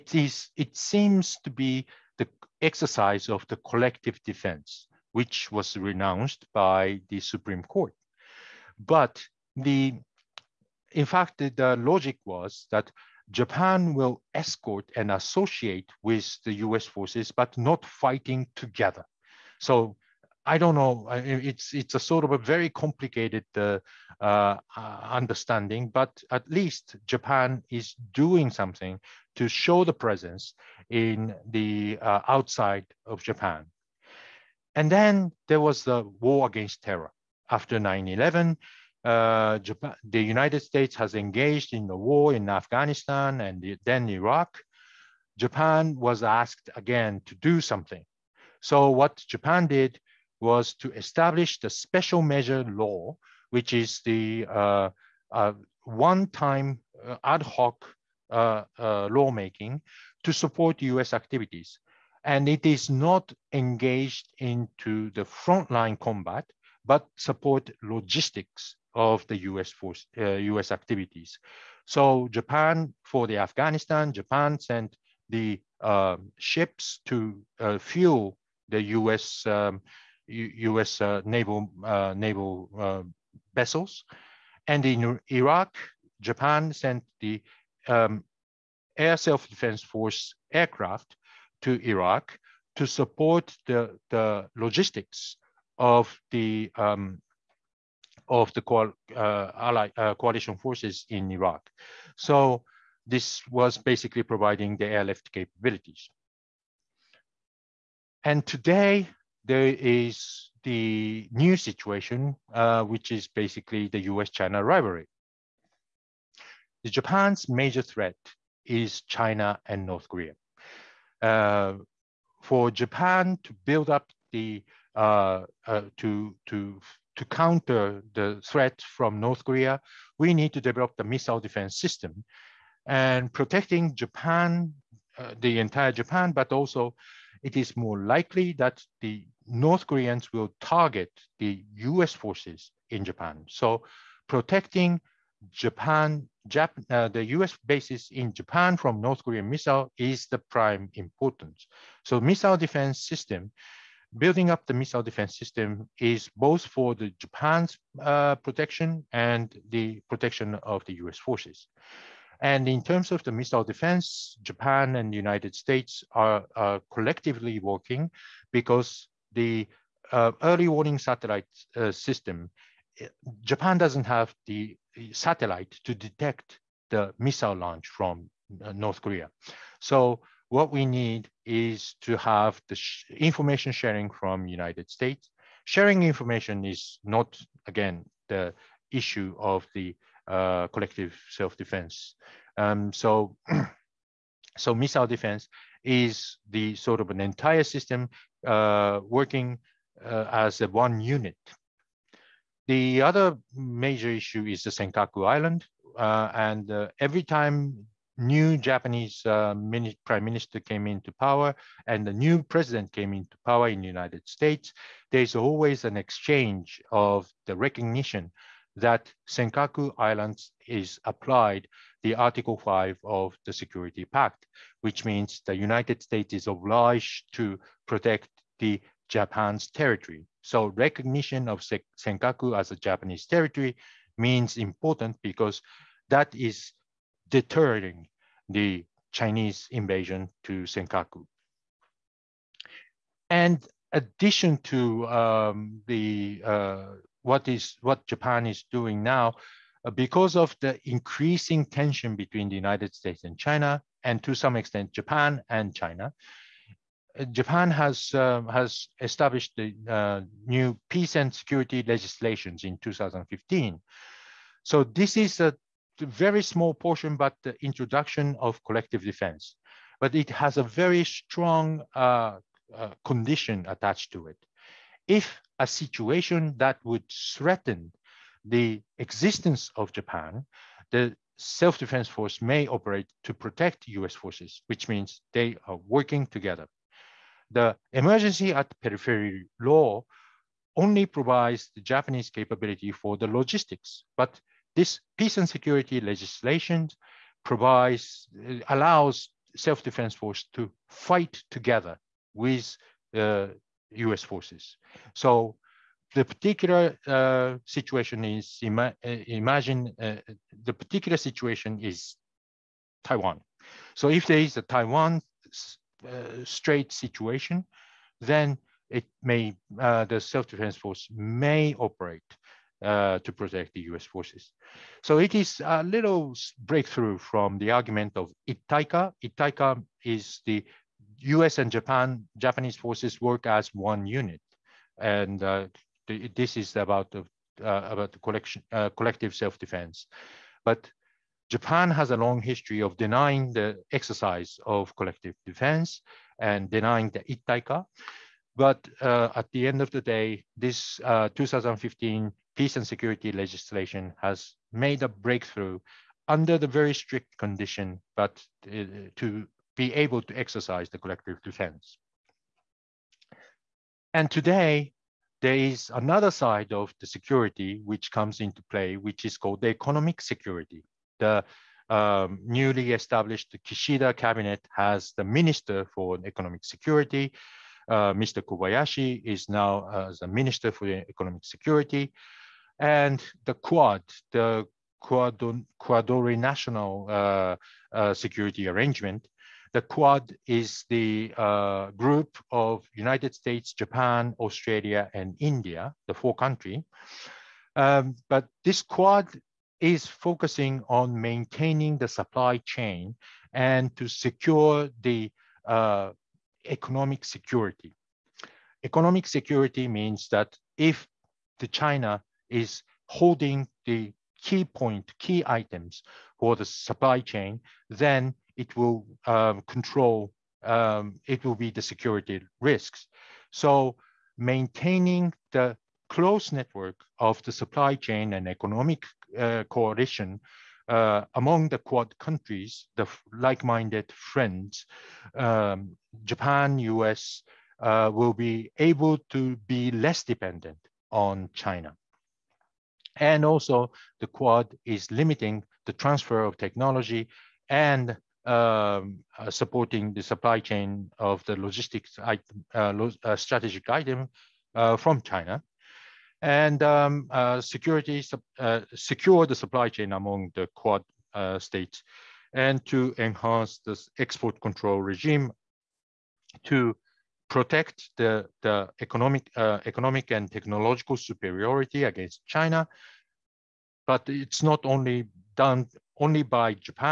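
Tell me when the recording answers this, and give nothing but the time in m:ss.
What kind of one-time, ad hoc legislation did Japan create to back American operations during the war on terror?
0:51.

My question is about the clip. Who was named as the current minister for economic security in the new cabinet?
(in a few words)
Kobayashi.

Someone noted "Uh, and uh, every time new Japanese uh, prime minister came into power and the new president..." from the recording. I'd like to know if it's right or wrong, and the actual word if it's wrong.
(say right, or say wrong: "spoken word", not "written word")
right.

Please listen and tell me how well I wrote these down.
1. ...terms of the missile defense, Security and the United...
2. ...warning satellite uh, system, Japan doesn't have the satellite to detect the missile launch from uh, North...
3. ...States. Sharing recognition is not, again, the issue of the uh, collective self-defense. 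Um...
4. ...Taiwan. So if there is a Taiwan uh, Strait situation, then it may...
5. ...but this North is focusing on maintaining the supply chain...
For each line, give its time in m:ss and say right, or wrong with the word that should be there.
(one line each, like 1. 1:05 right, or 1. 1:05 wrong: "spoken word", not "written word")
1. 2:42 wrong: "Japan", not "Security"
2. 2:50 right
3. 3:04 wrong: "information", not "recognition"
4. 5:13 right
5. 6:38 wrong: "Quad", not "North".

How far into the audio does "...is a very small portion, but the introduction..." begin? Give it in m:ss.
4:25.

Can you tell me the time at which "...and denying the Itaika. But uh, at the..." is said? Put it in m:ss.
5:46.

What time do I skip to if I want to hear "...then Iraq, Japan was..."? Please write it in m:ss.
0:43.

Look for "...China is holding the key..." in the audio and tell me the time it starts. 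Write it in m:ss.
6:51.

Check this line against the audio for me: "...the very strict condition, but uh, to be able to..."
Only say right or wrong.
right.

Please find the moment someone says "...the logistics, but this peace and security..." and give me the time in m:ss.
4:53.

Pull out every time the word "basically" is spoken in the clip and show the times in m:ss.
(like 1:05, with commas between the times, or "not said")
1:43, 1:53.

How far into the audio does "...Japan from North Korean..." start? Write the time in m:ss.
2:28.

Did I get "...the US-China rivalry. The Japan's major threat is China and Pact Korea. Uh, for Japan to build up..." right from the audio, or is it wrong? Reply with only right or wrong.
wrong.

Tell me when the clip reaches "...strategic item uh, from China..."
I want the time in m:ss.
7:33.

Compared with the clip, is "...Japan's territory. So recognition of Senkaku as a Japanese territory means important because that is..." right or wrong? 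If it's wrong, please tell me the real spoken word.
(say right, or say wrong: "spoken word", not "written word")
right.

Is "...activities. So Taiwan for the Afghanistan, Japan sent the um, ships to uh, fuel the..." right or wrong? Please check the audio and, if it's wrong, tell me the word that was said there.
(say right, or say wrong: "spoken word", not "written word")
wrong: "Japan", not "Taiwan".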